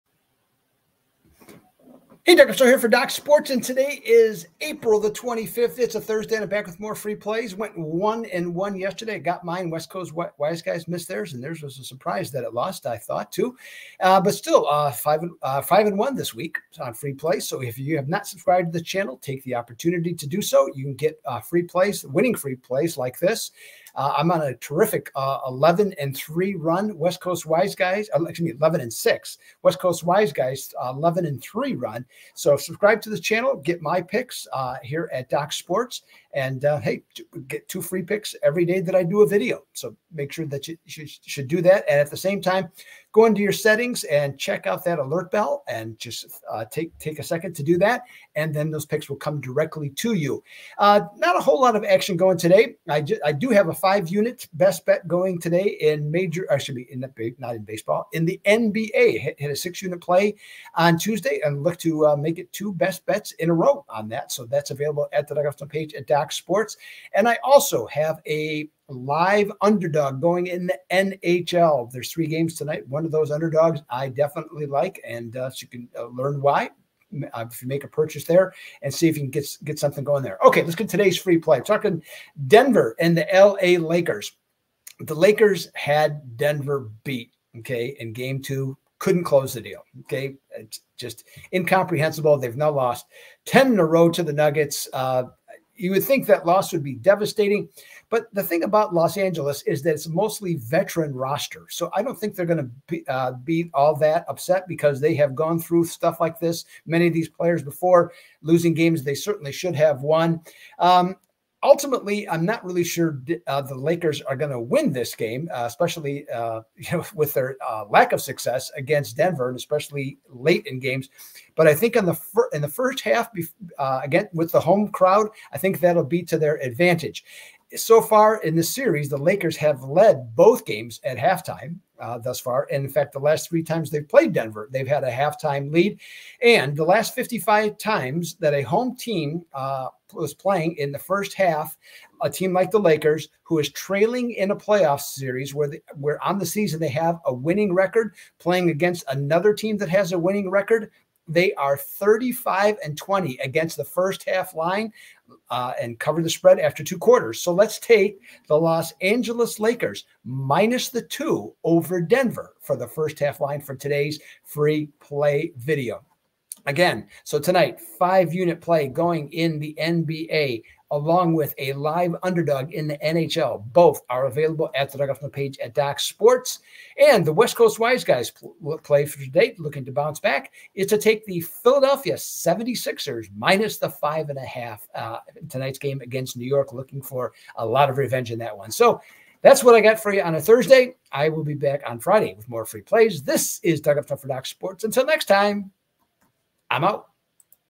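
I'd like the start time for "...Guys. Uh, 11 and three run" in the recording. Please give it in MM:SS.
00:30.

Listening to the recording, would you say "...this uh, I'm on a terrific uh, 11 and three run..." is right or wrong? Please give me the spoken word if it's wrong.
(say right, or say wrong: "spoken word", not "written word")
right.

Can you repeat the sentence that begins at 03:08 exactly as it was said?
So that's what I got for you on a Thursday.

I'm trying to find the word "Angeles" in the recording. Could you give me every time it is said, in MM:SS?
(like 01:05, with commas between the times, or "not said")
01:39, 02:39.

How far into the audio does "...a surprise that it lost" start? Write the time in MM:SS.
00:11.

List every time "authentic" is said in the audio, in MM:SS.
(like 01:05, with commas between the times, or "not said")
not said.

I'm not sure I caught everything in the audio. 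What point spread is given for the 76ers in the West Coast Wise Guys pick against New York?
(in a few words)
5.5.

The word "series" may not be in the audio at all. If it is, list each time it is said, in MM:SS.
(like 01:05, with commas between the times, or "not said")
02:08, 02:25.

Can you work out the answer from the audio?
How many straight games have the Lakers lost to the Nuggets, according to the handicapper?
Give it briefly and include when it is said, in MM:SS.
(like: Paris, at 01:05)
10, at 01:33.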